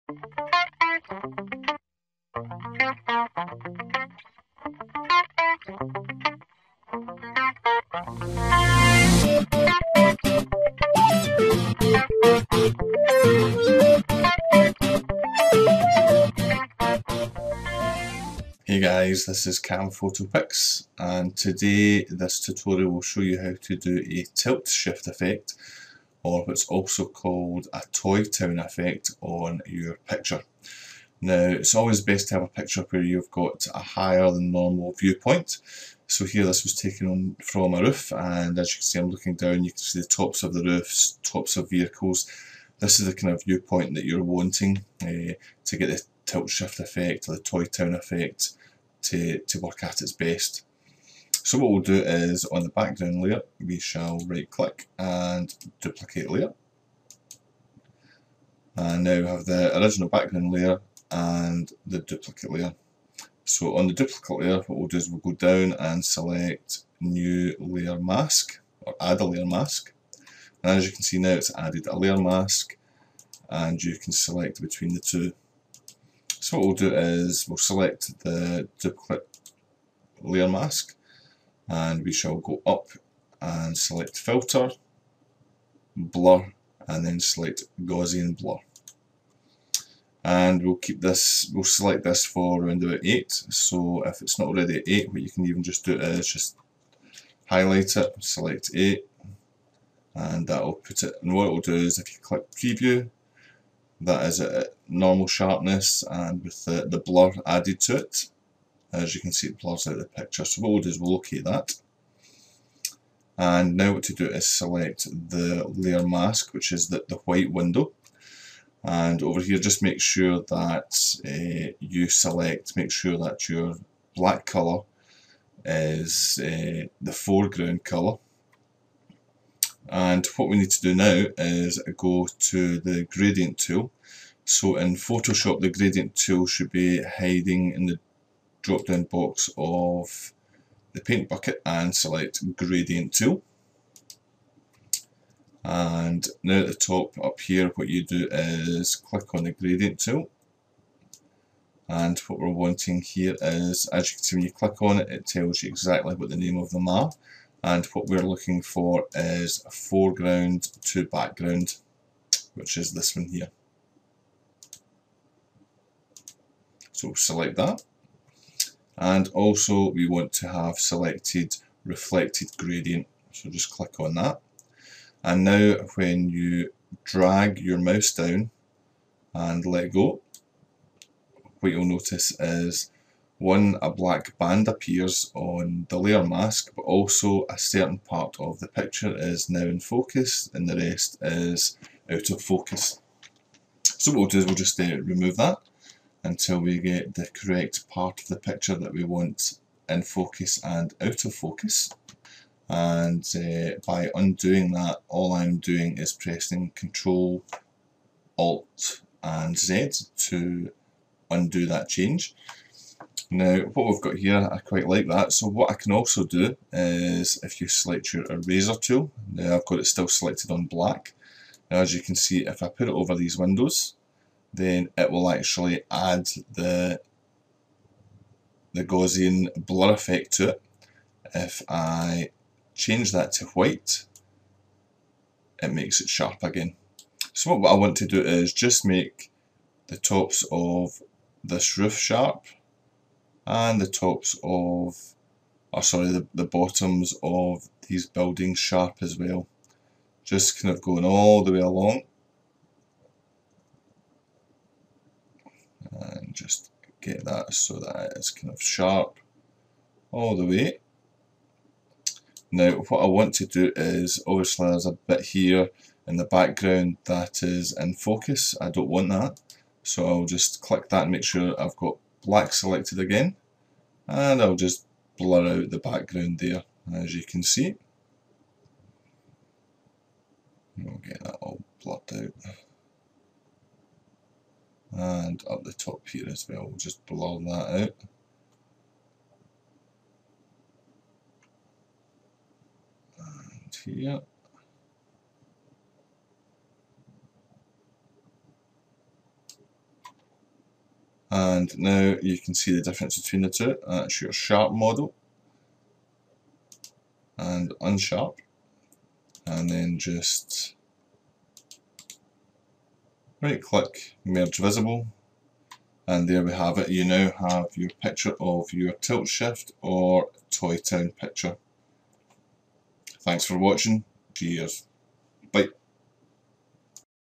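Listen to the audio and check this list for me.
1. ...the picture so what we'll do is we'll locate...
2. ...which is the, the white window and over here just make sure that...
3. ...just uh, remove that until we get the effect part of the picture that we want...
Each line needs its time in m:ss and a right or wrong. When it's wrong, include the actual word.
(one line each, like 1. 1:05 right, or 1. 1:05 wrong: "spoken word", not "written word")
1. 1:49 right
2. 1:56 right
3. 3:14 wrong: "correct", not "effect".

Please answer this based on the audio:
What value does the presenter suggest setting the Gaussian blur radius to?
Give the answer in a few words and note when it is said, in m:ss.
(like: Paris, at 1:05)
8, at 1:32.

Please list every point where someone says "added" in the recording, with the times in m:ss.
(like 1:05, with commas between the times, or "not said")
1:11, 1:47.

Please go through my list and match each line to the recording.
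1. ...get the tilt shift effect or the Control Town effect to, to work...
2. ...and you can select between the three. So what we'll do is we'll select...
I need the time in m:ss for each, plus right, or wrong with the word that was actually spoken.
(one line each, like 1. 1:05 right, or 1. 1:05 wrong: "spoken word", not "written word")
1. 0:45 wrong: "Toy", not "Control"
2. 1:13 wrong: "two", not "three".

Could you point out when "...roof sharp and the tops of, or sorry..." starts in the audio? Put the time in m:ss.
4:01.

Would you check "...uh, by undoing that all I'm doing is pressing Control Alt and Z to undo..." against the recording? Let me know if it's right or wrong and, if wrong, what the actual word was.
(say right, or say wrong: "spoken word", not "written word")
right.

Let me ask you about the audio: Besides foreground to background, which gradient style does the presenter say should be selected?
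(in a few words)
Reflected gradient.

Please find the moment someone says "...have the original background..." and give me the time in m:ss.
0:59.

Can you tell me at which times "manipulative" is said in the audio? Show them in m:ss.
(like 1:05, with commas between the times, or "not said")
not said.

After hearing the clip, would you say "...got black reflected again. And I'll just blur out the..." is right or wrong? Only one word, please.
wrong.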